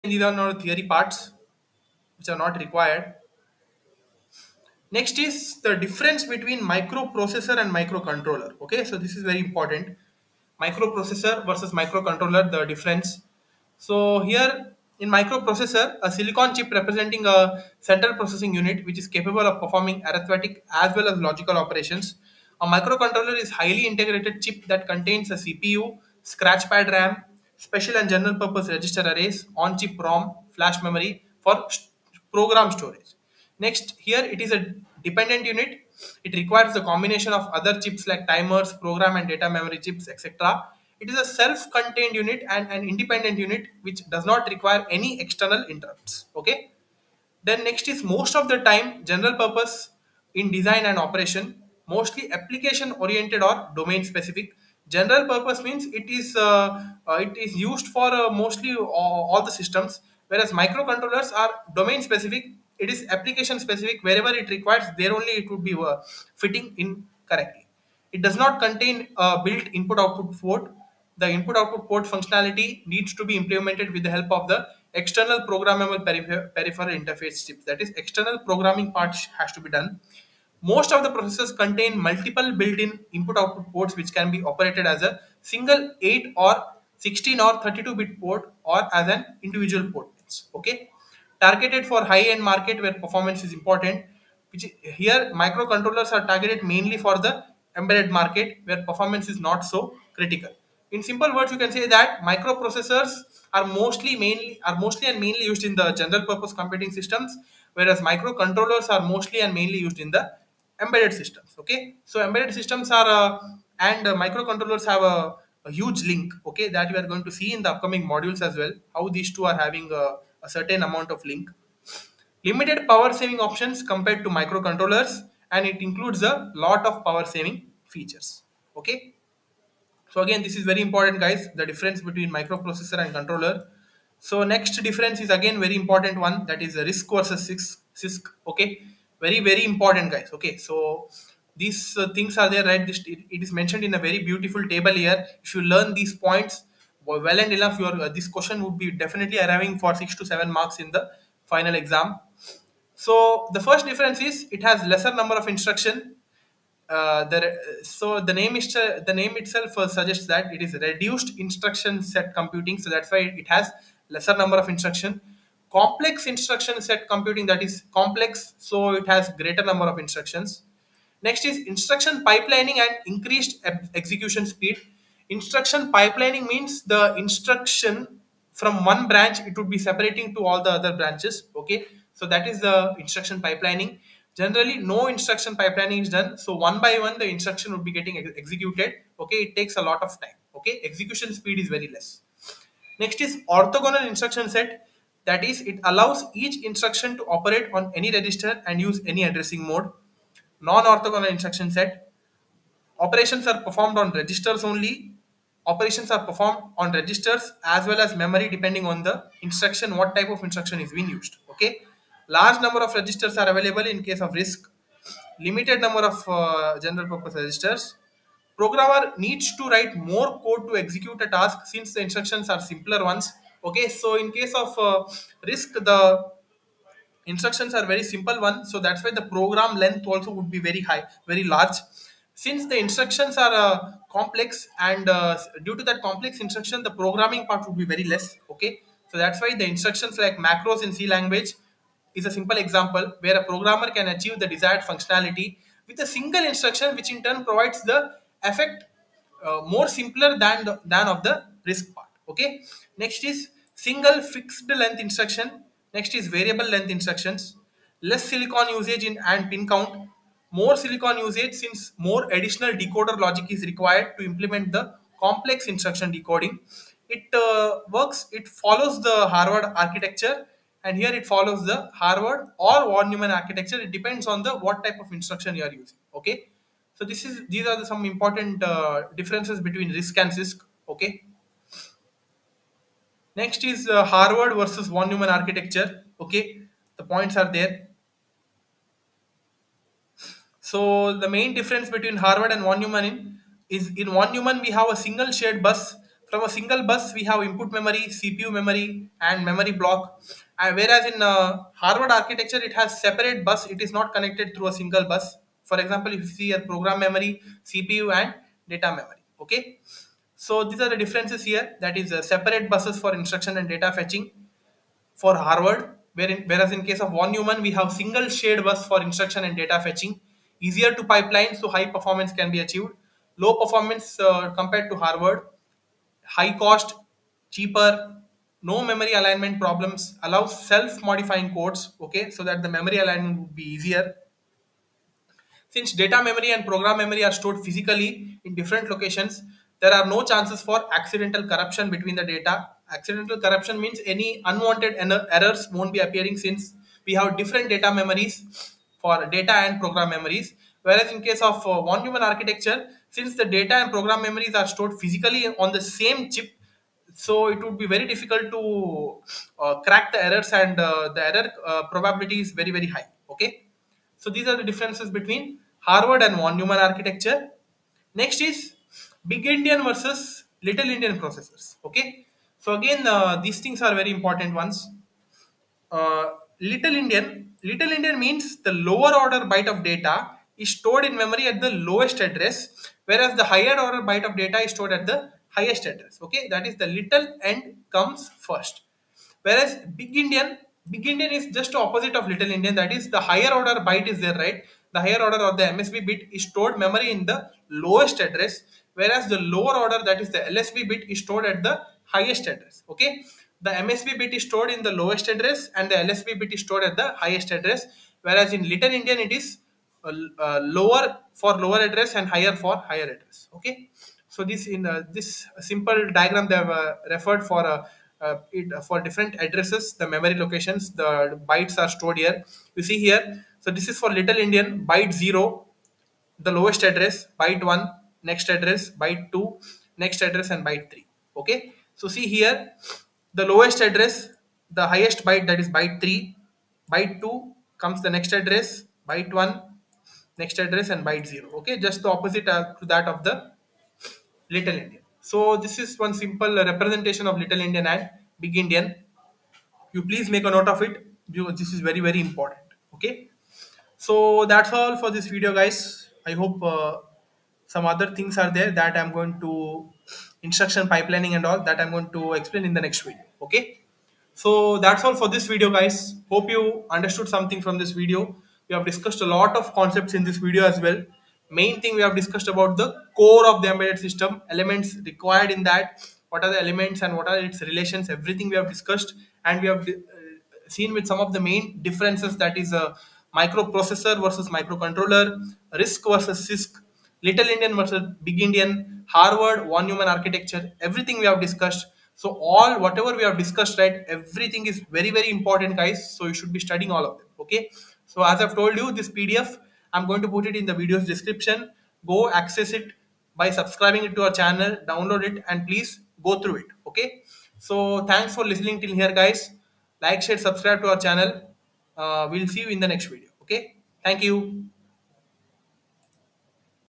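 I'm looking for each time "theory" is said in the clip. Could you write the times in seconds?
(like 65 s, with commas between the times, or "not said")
0 s.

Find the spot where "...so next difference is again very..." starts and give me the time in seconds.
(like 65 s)
134 s.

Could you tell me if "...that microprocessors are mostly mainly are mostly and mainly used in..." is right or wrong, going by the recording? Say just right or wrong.
right.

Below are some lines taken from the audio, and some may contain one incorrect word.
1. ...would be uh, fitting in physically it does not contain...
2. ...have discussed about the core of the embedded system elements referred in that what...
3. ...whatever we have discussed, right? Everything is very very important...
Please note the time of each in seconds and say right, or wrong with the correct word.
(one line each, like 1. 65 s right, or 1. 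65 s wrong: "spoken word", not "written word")
1. 65 s wrong: "correctly", not "physically"
2. 472 s wrong: "required", not "referred"
3. 492 s right.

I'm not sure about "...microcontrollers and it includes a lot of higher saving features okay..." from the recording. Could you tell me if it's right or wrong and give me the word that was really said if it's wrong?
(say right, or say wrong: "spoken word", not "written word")
wrong: "power", not "higher".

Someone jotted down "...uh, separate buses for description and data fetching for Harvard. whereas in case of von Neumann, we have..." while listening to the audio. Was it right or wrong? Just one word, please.
wrong.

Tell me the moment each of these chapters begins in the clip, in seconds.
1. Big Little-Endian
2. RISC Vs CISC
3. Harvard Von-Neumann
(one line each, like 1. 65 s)
1. 367 s
2. 135 s
3. 285 s.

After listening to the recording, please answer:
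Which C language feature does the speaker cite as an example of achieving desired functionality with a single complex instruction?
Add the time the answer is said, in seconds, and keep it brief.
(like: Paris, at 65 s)
Macros, at 240 s.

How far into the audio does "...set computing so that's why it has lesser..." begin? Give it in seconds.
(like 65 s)
162 s.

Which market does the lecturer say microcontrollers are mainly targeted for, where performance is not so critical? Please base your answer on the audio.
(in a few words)
Embedded market.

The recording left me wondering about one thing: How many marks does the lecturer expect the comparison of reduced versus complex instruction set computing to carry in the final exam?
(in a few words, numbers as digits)
6 to 7 marks.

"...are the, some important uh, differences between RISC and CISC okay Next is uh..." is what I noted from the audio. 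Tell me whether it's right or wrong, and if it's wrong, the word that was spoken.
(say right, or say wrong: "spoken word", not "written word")
right.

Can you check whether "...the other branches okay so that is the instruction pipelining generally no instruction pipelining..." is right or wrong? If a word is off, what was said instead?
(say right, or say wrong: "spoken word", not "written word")
right.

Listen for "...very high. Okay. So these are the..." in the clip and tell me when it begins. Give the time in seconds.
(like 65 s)
362 s.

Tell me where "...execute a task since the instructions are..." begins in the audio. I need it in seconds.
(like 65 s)
220 s.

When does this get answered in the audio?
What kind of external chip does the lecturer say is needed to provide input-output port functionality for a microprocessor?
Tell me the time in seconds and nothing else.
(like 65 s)
75 s.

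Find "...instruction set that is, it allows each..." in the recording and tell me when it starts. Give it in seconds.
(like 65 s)
194 s.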